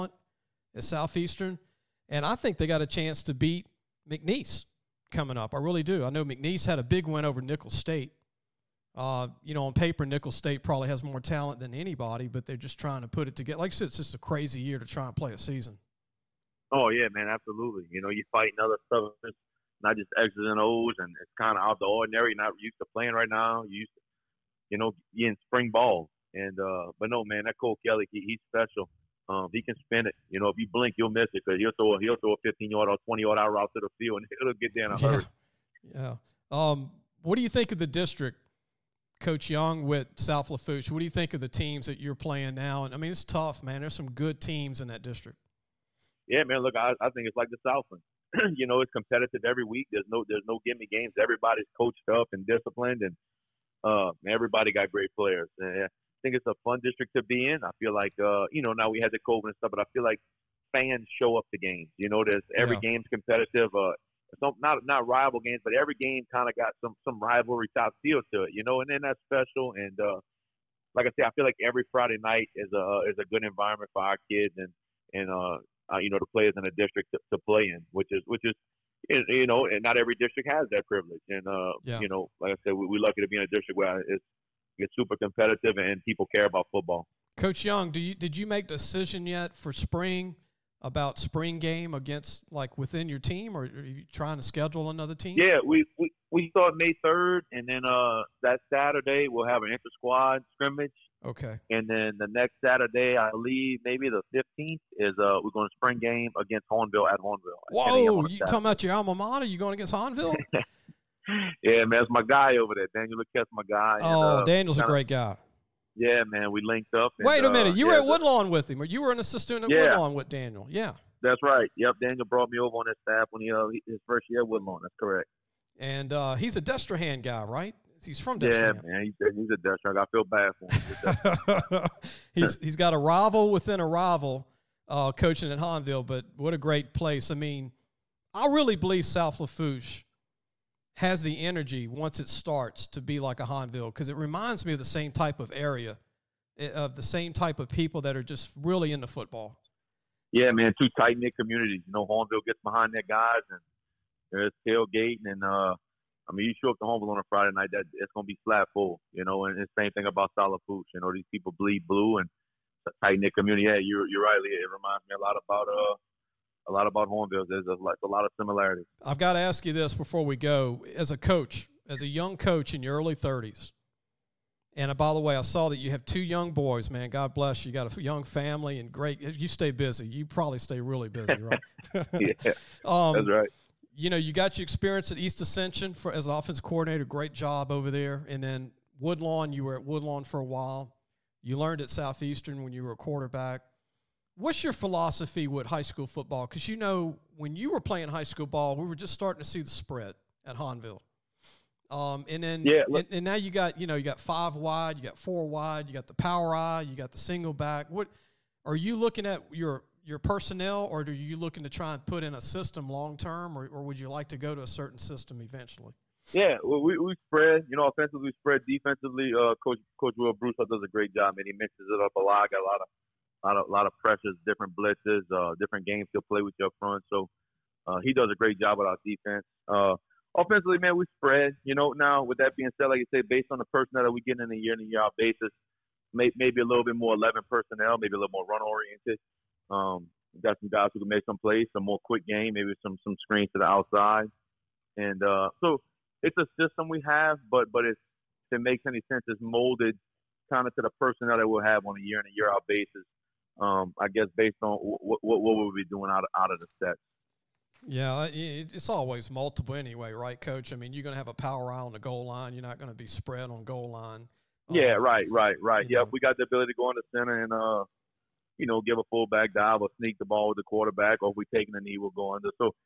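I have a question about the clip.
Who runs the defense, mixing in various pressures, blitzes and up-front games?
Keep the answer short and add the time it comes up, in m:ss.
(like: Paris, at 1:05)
Will Bruce, at 3:40.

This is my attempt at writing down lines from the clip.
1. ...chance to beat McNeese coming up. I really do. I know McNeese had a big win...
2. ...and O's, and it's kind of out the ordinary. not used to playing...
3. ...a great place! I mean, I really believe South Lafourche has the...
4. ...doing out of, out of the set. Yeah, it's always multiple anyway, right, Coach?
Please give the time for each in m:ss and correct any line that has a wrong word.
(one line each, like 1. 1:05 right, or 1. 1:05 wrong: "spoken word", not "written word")
1. 0:02 right
2. 0:20 right
3. 2:16 right
4. 4:15 right.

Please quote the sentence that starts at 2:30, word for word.
Yeah, man, two tight knit communities.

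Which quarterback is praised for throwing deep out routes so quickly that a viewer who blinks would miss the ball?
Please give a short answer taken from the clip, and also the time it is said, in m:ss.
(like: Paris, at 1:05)
Cole Kelley, at 0:27.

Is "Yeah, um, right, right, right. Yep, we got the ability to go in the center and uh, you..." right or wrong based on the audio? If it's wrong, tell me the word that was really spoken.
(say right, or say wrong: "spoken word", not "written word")
right.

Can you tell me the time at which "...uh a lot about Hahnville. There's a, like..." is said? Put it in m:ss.
2:45.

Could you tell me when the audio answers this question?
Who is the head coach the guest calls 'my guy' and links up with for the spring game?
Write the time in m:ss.
1:52.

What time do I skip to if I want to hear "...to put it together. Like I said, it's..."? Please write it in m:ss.
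0:13.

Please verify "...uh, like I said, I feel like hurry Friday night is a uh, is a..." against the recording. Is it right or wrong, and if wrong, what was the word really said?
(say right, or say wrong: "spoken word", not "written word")
wrong: "every", not "hurry".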